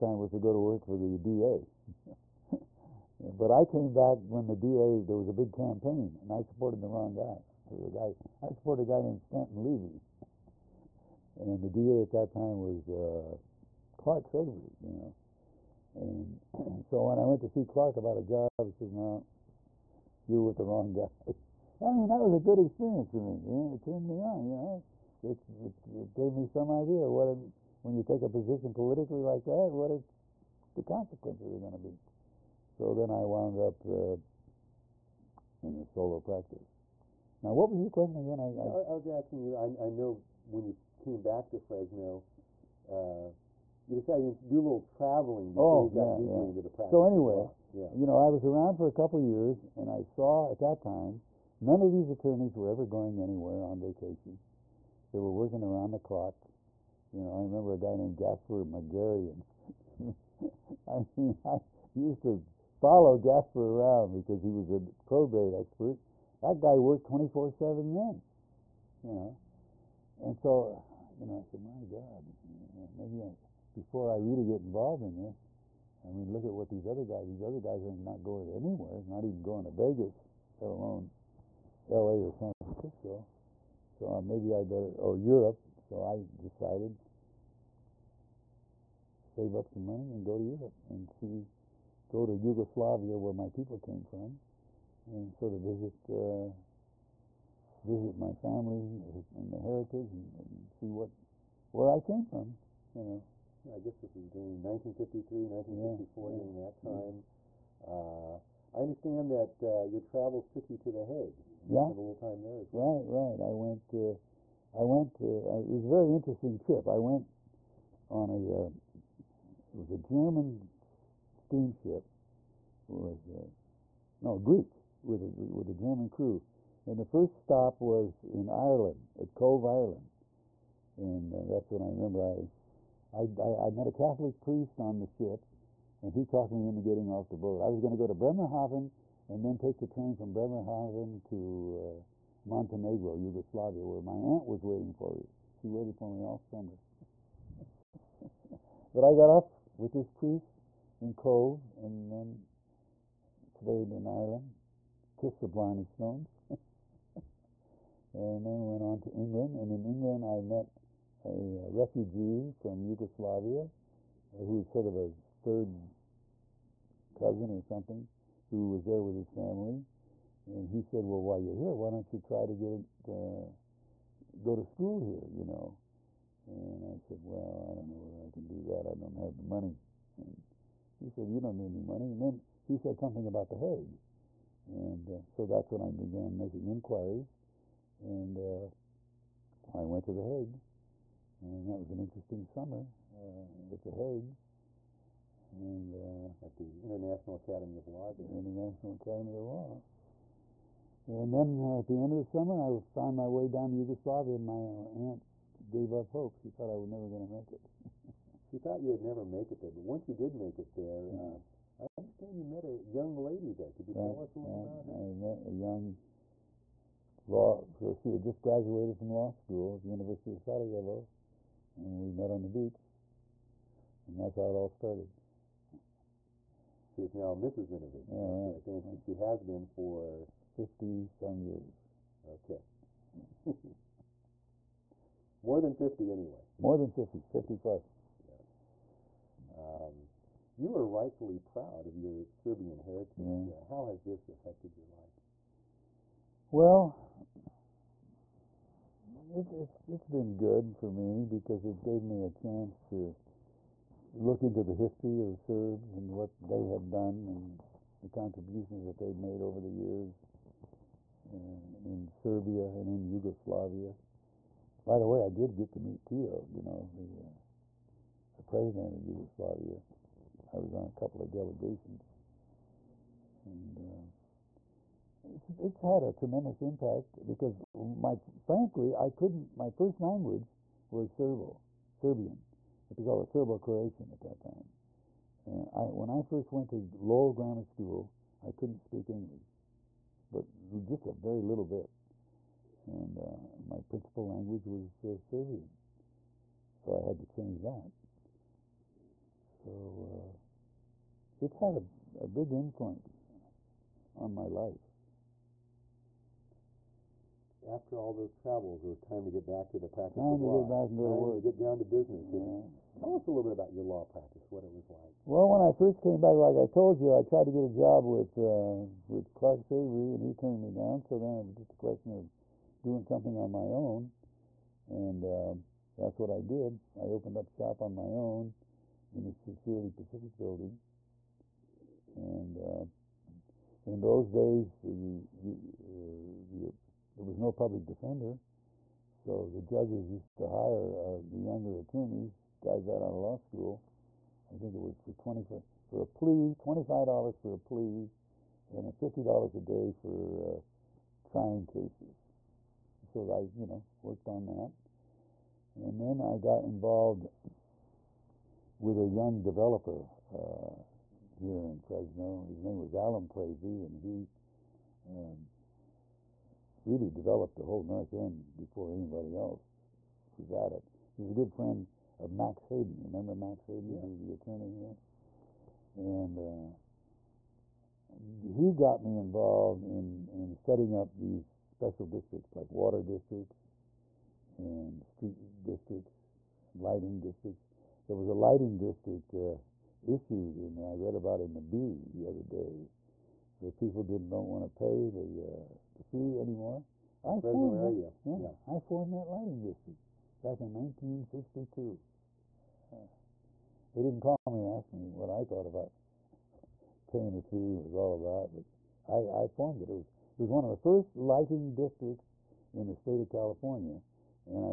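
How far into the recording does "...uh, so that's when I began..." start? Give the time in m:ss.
3:05.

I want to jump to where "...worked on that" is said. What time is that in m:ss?
5:54.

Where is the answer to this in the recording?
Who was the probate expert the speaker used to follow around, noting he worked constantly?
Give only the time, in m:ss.
0:58.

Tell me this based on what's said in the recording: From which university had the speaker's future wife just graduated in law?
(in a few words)
University of Sarajevo.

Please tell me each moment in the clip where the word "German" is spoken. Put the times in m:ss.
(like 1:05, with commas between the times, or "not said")
1:59, 2:05.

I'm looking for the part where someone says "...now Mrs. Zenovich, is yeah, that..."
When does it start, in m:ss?
3:47.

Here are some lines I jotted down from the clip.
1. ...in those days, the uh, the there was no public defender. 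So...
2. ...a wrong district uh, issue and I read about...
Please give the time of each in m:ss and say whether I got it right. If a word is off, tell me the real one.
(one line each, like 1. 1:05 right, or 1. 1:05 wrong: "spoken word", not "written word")
1. 5:33 right
2. 6:28 wrong: "lighting", not "wrong".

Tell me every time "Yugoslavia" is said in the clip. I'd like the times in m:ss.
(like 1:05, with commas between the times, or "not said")
1:32, 2:23, 2:42, 3:23, 4:23, 4:29.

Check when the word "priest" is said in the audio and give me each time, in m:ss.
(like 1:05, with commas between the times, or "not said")
2:14, 2:30.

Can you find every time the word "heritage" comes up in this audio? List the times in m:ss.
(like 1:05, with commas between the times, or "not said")
1:39, 4:02.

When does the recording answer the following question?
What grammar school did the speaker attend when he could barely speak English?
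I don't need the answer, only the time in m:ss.
4:46.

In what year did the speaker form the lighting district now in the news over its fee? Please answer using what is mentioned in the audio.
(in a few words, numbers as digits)
1962.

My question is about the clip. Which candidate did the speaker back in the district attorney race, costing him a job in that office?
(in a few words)
Stanton Levy.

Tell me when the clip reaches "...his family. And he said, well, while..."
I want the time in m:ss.
2:49.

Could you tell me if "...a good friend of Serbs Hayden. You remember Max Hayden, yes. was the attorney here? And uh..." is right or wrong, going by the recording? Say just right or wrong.
wrong.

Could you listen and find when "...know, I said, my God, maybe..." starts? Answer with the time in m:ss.
1:11.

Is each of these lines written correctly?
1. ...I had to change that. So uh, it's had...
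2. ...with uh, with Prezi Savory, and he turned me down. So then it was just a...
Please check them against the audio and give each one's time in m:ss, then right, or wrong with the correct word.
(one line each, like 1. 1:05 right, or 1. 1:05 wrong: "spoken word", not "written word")
1. 4:57 right
2. 5:18 wrong: "Clark", not "Prezi".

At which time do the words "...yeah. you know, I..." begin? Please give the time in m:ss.
0:47.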